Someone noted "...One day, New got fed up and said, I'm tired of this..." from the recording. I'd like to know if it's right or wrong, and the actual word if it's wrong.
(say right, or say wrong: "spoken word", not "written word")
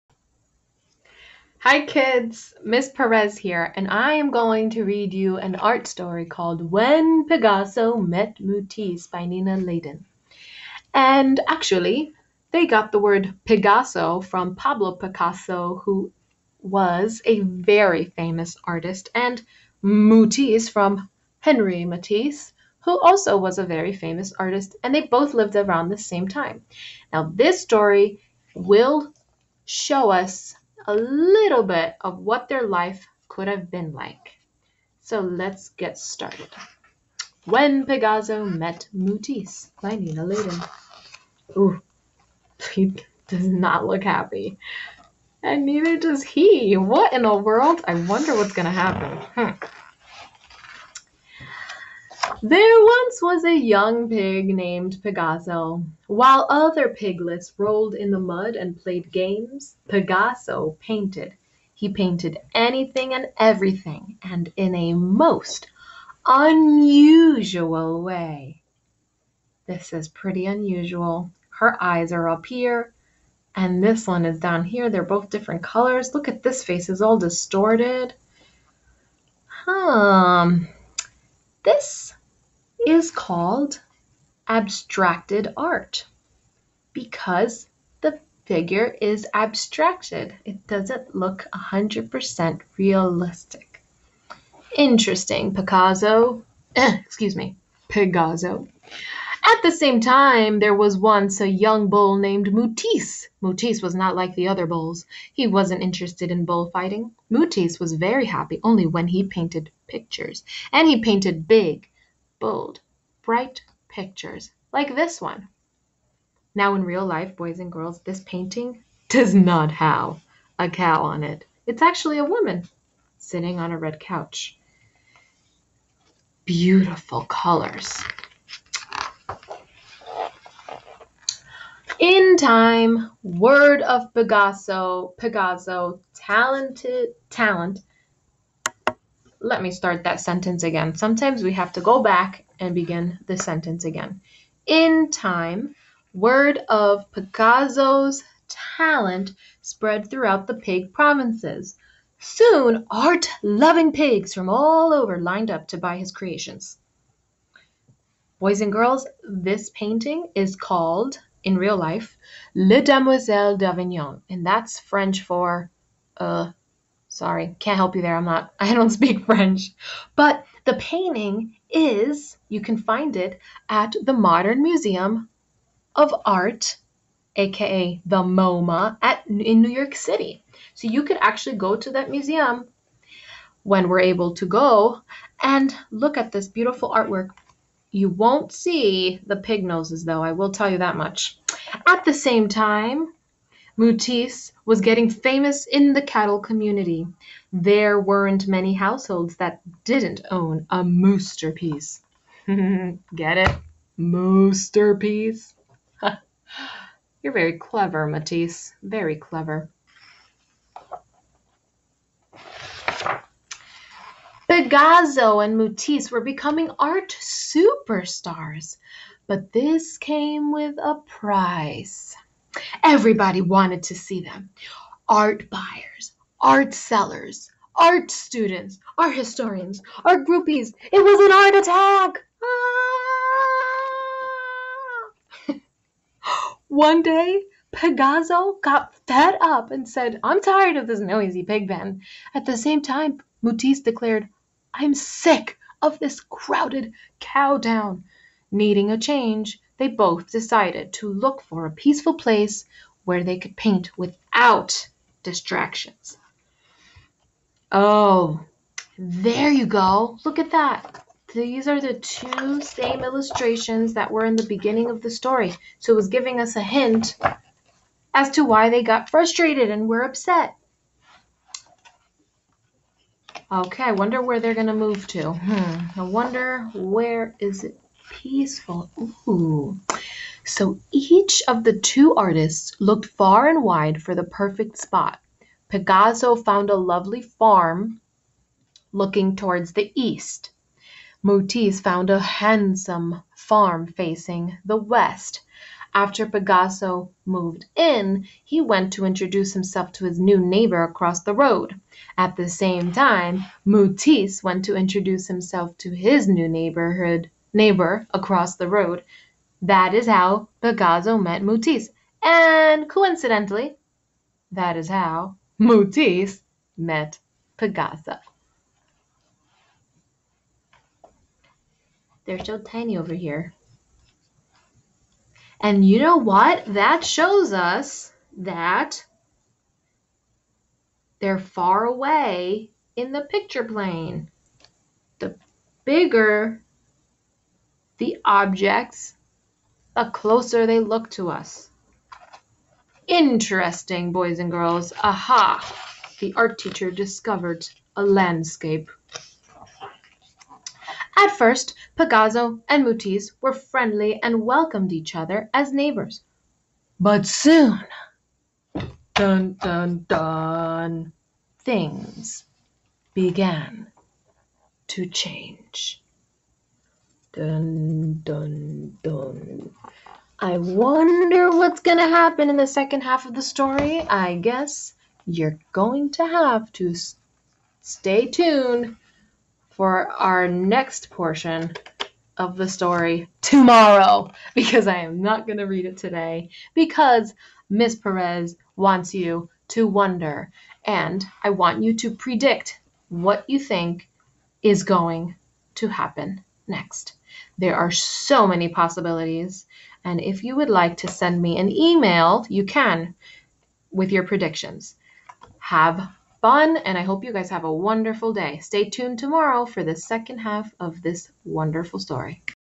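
wrong: "Pigasso", not "New".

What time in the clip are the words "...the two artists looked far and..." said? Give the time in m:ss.
4:41.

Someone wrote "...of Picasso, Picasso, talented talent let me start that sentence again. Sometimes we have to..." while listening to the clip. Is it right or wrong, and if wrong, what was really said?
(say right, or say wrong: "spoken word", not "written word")
right.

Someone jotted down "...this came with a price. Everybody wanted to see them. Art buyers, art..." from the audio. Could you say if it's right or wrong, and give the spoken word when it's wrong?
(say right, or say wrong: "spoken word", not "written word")
right.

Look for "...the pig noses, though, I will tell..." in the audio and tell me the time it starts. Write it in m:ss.
3:09.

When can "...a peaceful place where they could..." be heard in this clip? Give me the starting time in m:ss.
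4:11.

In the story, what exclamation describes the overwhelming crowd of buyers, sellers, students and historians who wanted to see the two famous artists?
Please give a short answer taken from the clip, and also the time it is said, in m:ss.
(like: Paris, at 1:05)
An art attack, at 3:51.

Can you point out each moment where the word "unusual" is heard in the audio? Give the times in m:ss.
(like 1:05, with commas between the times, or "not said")
1:06, 1:10.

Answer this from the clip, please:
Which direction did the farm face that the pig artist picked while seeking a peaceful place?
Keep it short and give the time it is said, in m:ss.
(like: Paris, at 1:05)
east, at 4:49.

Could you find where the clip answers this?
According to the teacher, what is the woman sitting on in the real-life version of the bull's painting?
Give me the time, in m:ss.
2:03.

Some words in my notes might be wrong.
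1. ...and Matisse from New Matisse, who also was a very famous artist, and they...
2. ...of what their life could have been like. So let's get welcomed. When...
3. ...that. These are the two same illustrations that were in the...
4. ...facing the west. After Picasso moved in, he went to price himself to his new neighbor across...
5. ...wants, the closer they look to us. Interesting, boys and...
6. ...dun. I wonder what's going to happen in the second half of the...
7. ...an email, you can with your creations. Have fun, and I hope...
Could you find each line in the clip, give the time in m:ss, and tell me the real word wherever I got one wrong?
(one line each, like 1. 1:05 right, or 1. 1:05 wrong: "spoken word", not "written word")
1. 0:19 wrong: "Henri", not "New"
2. 0:32 wrong: "started", not "welcomed"
3. 4:20 right
4. 4:53 wrong: "introduce", not "price"
5. 5:38 wrong: "objects", not "wants"
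6. 6:09 right
7. 6:41 wrong: "predictions", not "creations".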